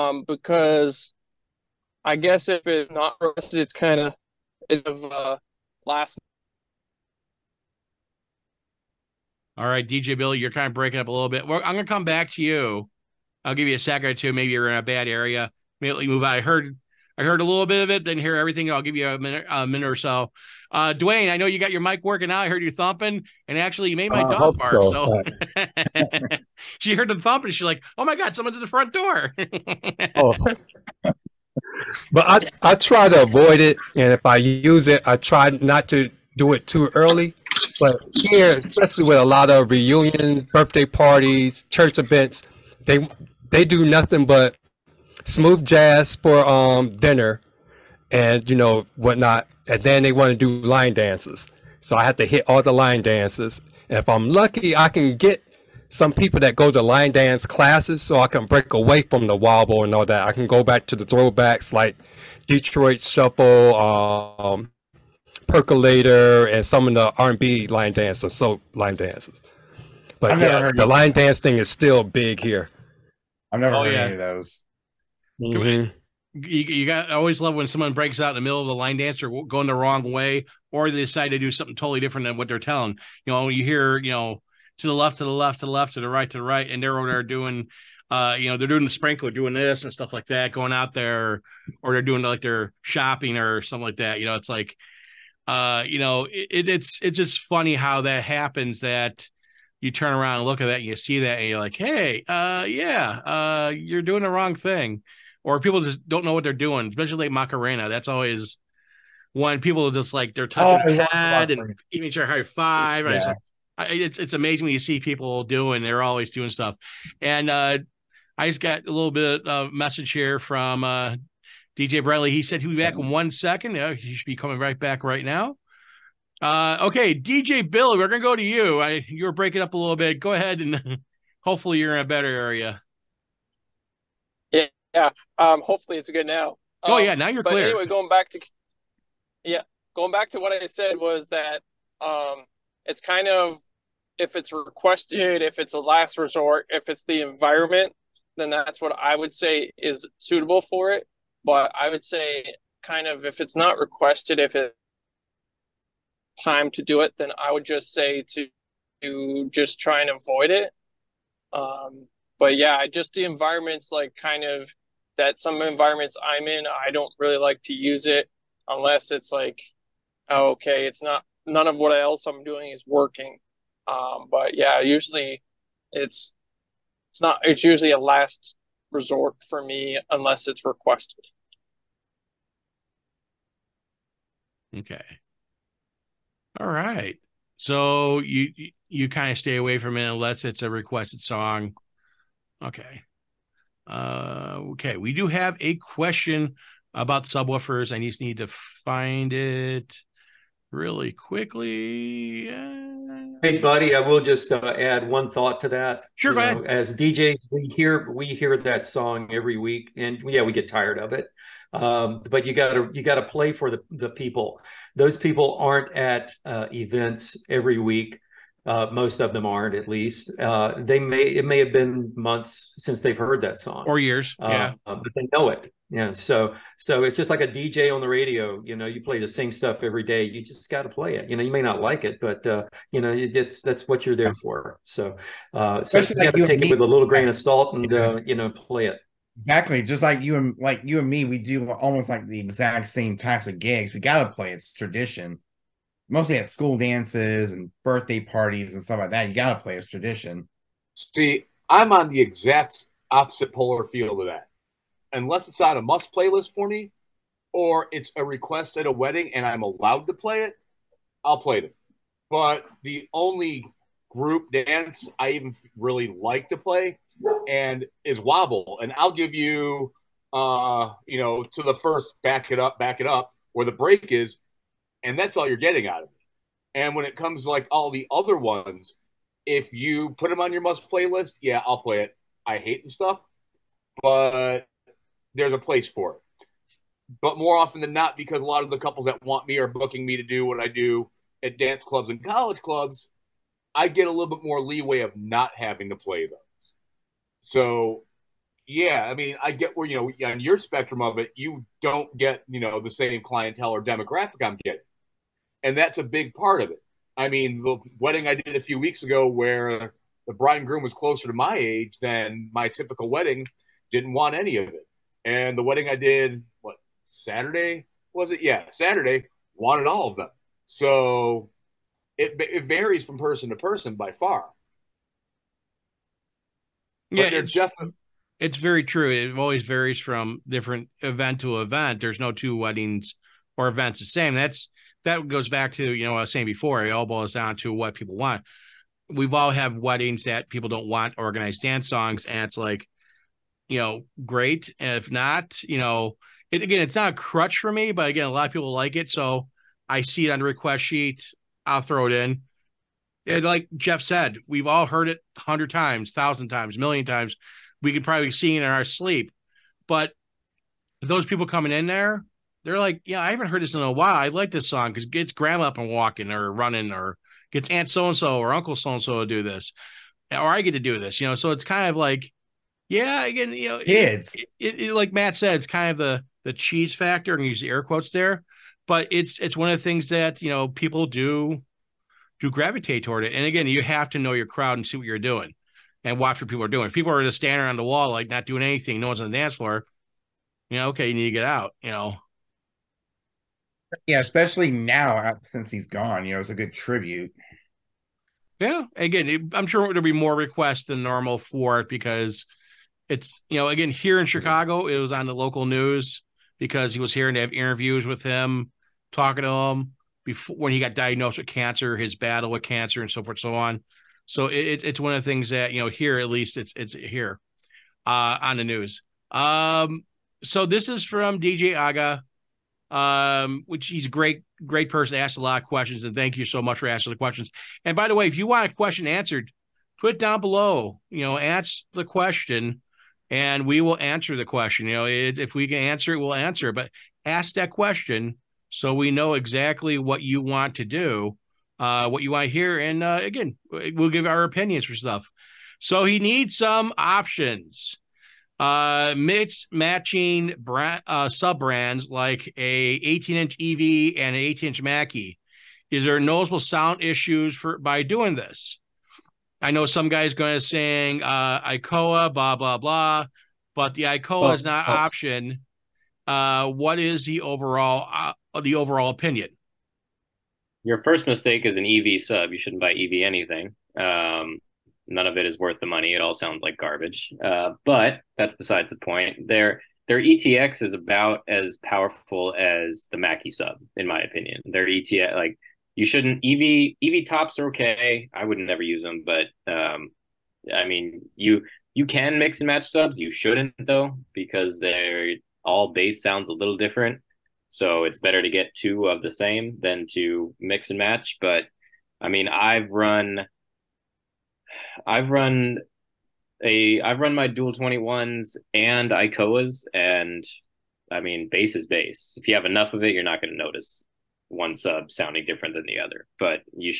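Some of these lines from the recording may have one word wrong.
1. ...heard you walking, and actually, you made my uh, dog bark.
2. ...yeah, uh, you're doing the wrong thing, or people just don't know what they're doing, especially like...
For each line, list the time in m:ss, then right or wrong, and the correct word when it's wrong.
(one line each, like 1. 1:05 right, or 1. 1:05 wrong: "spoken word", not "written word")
1. 0:22 wrong: "thumping", not "walking"
2. 1:42 right.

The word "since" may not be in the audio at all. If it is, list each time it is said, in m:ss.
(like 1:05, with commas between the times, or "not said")
3:42, 6:35.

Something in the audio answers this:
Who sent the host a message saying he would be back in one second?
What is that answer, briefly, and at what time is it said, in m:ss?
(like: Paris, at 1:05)
DJ Bradley, at 2:01.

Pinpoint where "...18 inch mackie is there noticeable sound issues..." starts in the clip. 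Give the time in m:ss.
7:34.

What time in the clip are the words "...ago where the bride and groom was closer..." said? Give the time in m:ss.
5:09.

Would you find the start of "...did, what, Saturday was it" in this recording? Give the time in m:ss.
5:15.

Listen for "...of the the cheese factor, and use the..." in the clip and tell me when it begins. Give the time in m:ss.
6:15.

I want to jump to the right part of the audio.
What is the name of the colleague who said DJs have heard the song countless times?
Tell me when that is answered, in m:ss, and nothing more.
5:53.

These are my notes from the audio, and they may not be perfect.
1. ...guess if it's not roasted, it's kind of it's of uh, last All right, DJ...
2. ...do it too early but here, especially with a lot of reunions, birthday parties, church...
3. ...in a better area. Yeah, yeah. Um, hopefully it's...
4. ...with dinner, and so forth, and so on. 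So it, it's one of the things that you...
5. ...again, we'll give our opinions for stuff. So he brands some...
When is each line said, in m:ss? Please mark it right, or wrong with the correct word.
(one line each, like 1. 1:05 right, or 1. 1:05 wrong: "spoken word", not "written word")
1. 0:02 right
2. 0:36 right
3. 2:11 right
4. 6:52 wrong: "cancer", not "dinner"
5. 7:23 wrong: "needs", not "brands".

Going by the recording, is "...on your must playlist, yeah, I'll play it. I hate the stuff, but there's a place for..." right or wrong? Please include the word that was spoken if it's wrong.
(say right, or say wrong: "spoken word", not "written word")
right.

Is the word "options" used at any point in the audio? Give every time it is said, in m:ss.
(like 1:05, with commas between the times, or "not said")
7:26, 7:44.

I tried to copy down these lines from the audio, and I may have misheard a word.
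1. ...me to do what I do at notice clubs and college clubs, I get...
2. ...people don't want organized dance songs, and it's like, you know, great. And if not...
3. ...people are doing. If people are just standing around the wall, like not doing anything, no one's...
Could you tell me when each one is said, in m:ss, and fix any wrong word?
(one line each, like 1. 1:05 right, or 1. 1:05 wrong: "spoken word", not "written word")
1. 4:50 wrong: "dance", not "notice"
2. 5:40 right
3. 6:26 right.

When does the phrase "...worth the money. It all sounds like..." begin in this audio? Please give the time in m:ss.
7:55.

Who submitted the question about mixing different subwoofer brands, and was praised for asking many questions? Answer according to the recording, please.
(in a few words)
DJ Aga.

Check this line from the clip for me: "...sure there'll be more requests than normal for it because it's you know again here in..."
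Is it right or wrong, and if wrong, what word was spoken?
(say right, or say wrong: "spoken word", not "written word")
right.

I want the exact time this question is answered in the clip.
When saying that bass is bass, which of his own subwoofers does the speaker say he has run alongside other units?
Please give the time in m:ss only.
8:27.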